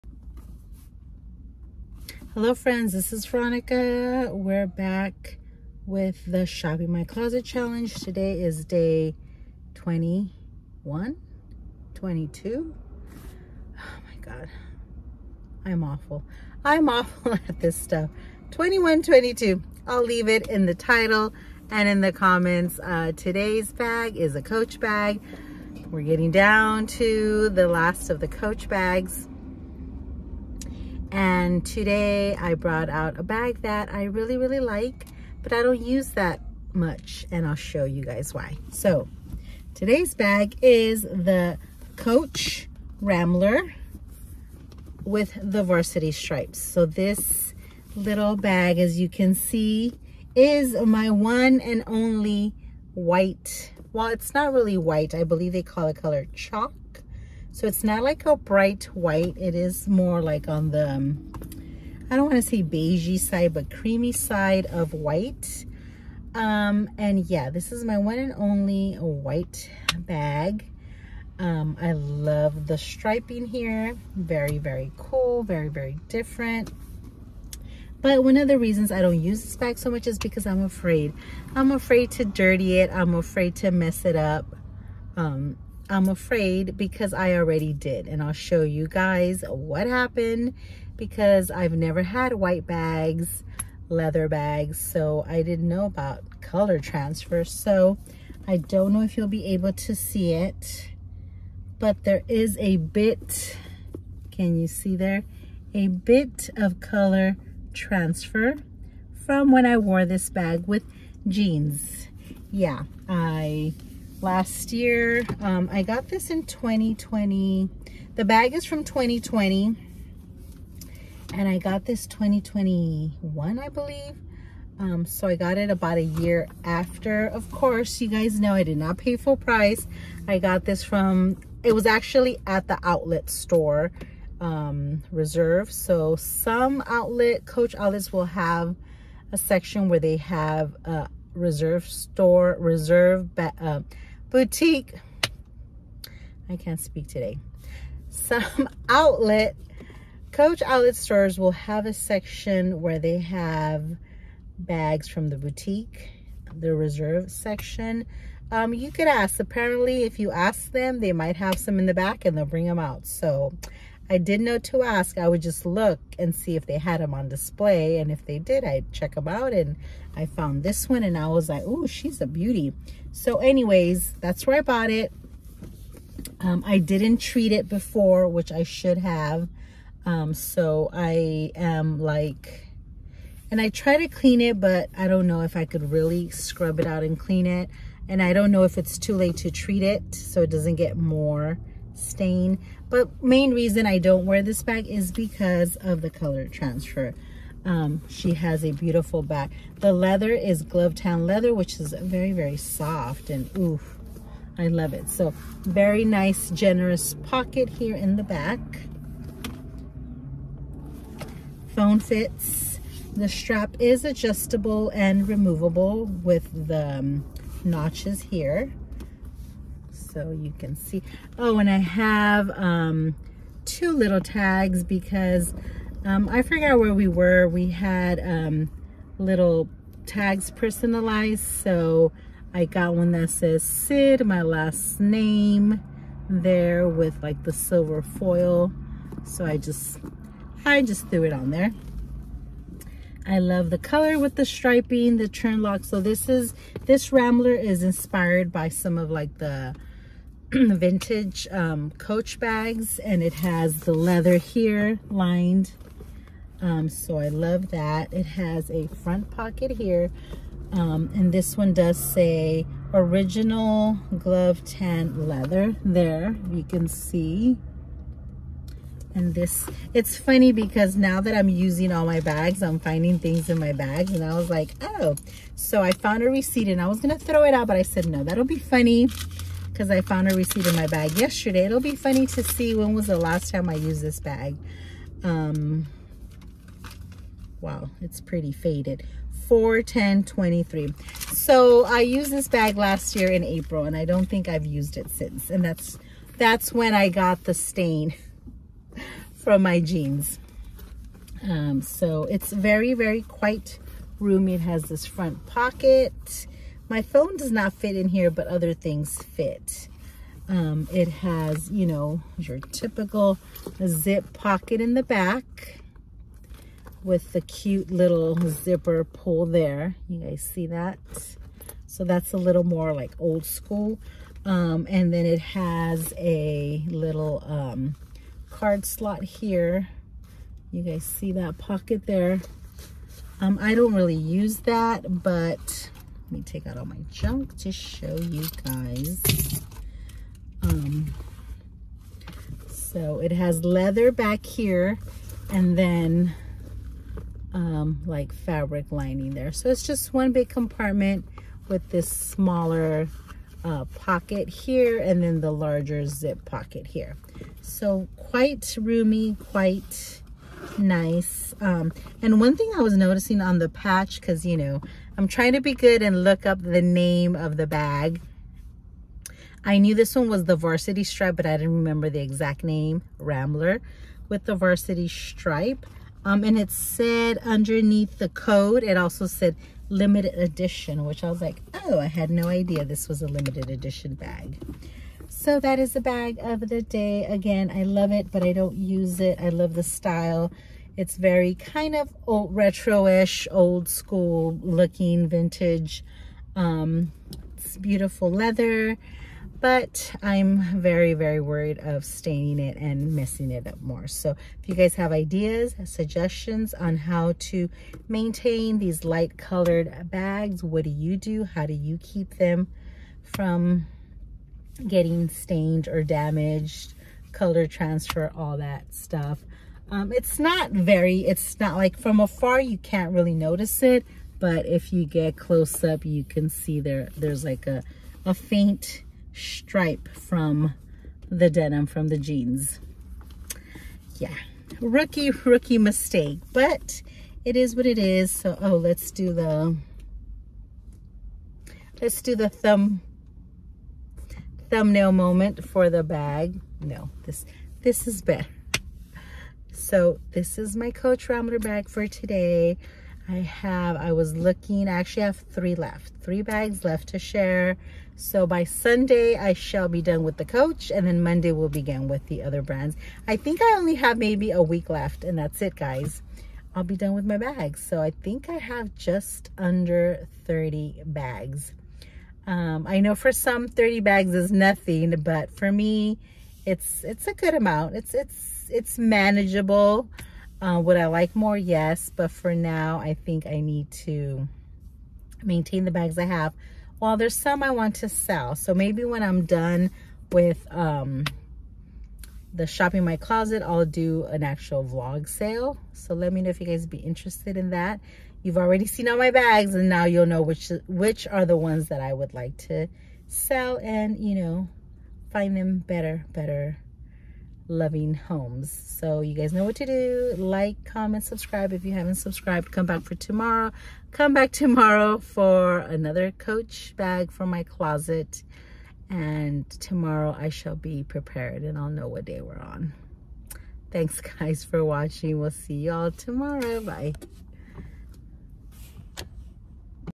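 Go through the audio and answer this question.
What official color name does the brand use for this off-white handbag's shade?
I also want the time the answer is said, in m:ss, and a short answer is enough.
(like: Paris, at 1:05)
chalk, at 0:55.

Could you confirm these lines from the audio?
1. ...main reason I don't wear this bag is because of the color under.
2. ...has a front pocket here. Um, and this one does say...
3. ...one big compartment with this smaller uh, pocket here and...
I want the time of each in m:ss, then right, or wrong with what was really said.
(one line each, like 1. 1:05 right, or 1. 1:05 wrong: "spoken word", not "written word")
1. 3:13 wrong: "transfer", not "under"
2. 4:18 right
3. 5:50 right.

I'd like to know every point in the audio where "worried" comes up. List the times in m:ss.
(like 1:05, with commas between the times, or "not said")
6:41.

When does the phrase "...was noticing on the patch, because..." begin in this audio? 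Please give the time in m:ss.
6:02.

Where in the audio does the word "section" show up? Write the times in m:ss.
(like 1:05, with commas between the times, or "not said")
2:19, 2:31, 2:37.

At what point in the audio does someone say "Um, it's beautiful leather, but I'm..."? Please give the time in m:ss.
6:36.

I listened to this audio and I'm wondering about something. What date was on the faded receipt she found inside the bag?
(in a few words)
4/10/23.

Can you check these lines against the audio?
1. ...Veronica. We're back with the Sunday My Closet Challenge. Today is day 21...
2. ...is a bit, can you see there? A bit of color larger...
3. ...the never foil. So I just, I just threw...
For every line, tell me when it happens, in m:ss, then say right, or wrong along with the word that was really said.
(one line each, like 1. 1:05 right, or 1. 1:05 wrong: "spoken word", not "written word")
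1. 0:03 wrong: "Shopping", not "Sunday"
2. 1:42 wrong: "transfer", not "larger"
3. 3:57 wrong: "silver", not "never".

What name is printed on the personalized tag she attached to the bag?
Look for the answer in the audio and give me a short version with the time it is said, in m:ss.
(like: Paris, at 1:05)
Cid, at 3:53.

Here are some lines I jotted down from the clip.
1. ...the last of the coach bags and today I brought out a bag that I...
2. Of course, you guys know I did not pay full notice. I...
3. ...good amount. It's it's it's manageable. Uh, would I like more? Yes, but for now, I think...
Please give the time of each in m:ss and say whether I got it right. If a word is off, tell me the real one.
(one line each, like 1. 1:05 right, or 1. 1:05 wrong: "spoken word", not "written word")
1. 0:27 right
2. 2:07 wrong: "price", not "notice"
3. 7:57 right.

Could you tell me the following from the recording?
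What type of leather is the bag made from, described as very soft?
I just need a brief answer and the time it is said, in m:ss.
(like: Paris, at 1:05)
Glovetanned leather, at 3:20.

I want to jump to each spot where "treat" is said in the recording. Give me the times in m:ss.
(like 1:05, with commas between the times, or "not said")
2:57, 3:09.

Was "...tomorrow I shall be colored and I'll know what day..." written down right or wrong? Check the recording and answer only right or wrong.
wrong.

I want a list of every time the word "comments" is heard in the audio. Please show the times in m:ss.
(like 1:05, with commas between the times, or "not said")
0:22, 8:30.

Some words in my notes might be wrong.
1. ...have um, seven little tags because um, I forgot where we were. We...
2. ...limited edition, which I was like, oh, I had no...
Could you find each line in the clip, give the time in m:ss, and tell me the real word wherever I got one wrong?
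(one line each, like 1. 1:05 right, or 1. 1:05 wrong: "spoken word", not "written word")
1. 3:41 wrong: "two", not "seven"
2. 6:19 right.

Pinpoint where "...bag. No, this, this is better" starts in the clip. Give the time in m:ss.
7:26.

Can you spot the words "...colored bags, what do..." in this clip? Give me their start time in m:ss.
6:49.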